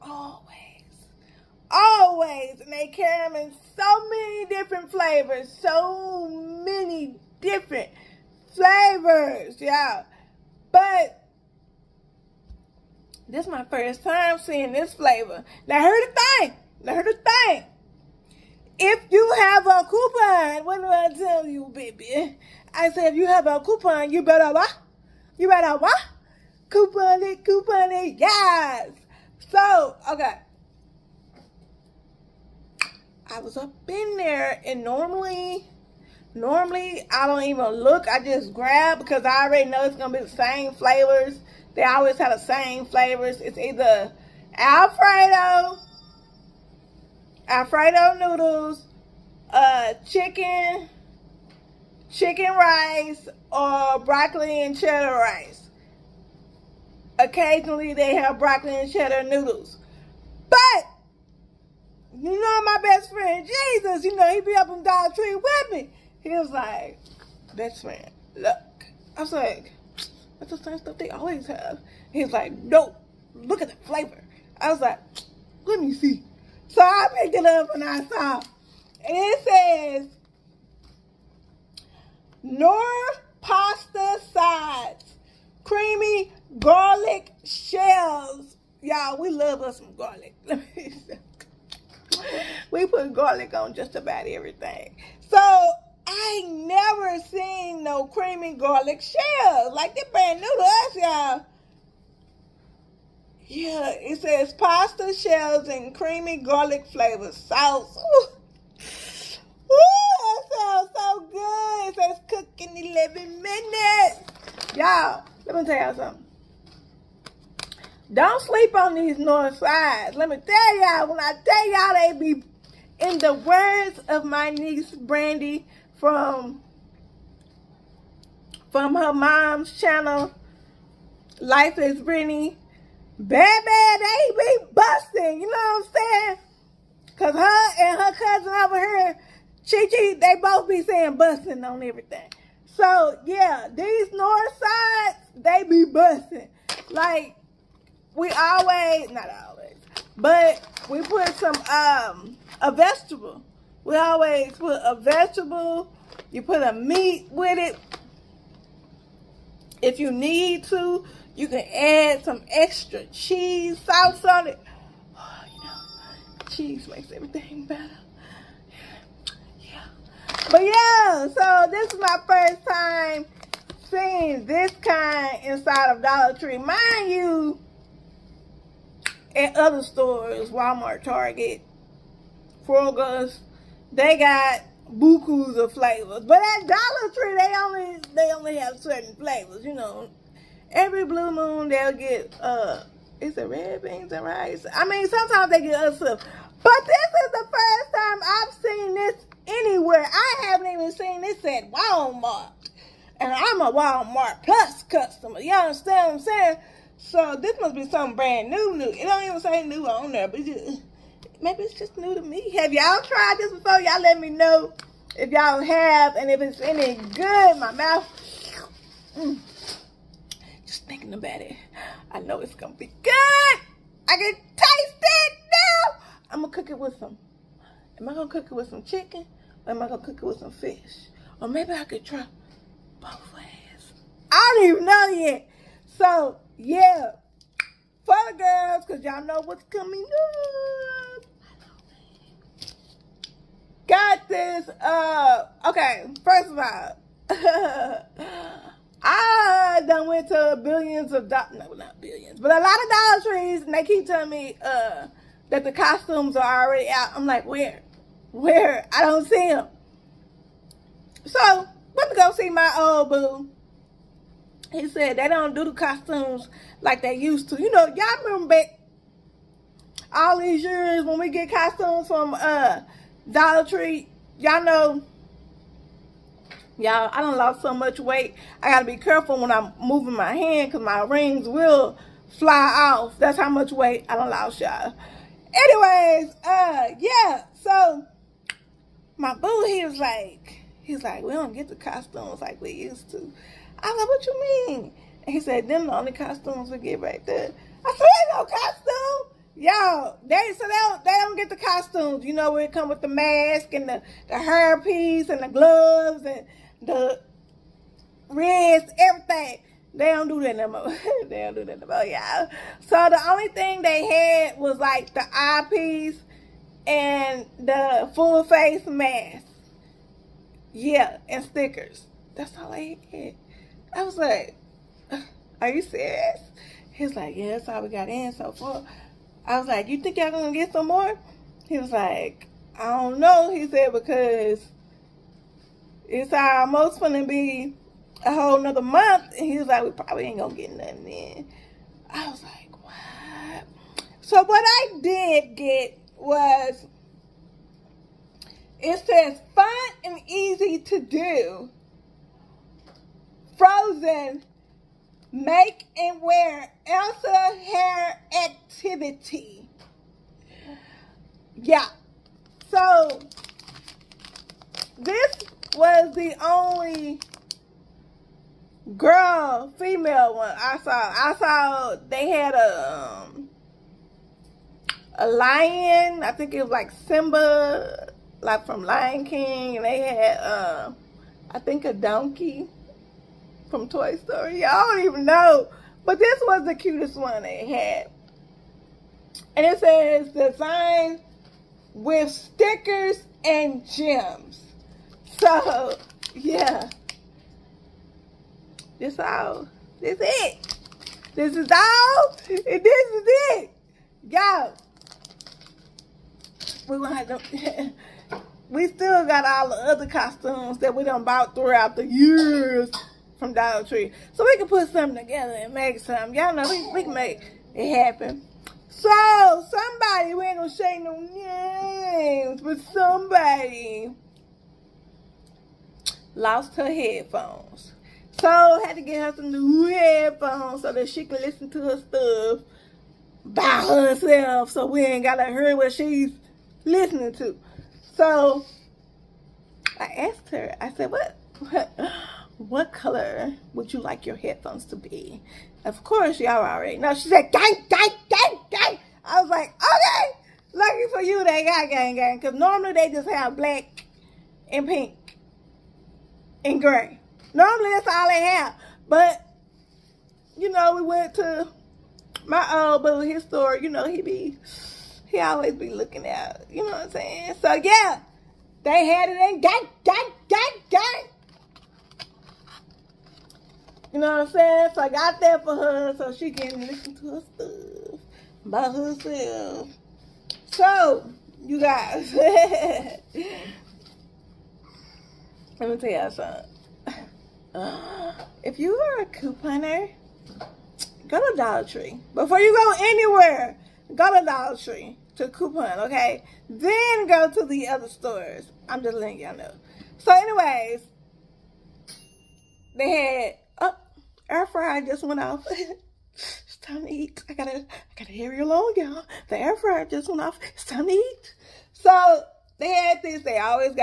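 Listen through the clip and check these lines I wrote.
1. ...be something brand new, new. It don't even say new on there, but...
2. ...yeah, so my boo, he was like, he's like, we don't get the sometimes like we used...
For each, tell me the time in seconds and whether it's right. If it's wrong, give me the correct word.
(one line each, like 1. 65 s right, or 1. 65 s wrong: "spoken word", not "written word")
1. 207 s right
2. 286 s wrong: "costumes", not "sometimes".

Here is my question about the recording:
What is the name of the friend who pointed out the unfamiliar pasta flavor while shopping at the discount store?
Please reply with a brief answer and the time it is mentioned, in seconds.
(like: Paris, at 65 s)
Jesus, at 63 s.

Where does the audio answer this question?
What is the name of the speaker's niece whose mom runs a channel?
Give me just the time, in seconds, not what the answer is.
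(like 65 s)
124 s.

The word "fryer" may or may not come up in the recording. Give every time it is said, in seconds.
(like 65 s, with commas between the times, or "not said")
504 s, 509 s.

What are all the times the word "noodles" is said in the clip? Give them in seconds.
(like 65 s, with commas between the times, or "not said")
48 s, 59 s.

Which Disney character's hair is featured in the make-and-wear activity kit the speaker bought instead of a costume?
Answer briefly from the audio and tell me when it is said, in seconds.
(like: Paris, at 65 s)
Elsa, at 356 s.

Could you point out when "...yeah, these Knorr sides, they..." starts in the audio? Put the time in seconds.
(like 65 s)
143 s.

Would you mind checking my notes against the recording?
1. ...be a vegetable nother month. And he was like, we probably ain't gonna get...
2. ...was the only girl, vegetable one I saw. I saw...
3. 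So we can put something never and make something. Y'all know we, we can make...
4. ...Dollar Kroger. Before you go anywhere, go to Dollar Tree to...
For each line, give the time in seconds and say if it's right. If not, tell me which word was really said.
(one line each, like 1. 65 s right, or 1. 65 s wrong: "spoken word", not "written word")
1. 337 s wrong: "whole", not "vegetable"
2. 365 s wrong: "female", not "vegetable"
3. 414 s wrong: "together", not "never"
4. 491 s wrong: "Tree", not "Kroger".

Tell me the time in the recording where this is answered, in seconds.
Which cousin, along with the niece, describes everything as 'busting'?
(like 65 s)
139 s.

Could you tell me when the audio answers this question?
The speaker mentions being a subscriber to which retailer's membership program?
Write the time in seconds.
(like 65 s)
203 s.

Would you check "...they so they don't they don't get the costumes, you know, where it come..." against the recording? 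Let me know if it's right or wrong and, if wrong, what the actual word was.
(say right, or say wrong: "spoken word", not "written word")
right.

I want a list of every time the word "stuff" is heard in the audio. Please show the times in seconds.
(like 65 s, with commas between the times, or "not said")
70 s, 195 s, 431 s, 477 s.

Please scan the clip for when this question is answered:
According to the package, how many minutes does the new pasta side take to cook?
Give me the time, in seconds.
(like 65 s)
112 s.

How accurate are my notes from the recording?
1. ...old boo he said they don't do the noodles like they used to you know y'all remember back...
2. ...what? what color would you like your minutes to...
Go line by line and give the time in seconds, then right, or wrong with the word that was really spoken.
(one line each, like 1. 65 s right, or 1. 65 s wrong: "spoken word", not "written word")
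1. 262 s wrong: "costumes", not "noodles"
2. 441 s wrong: "headphones", not "minutes".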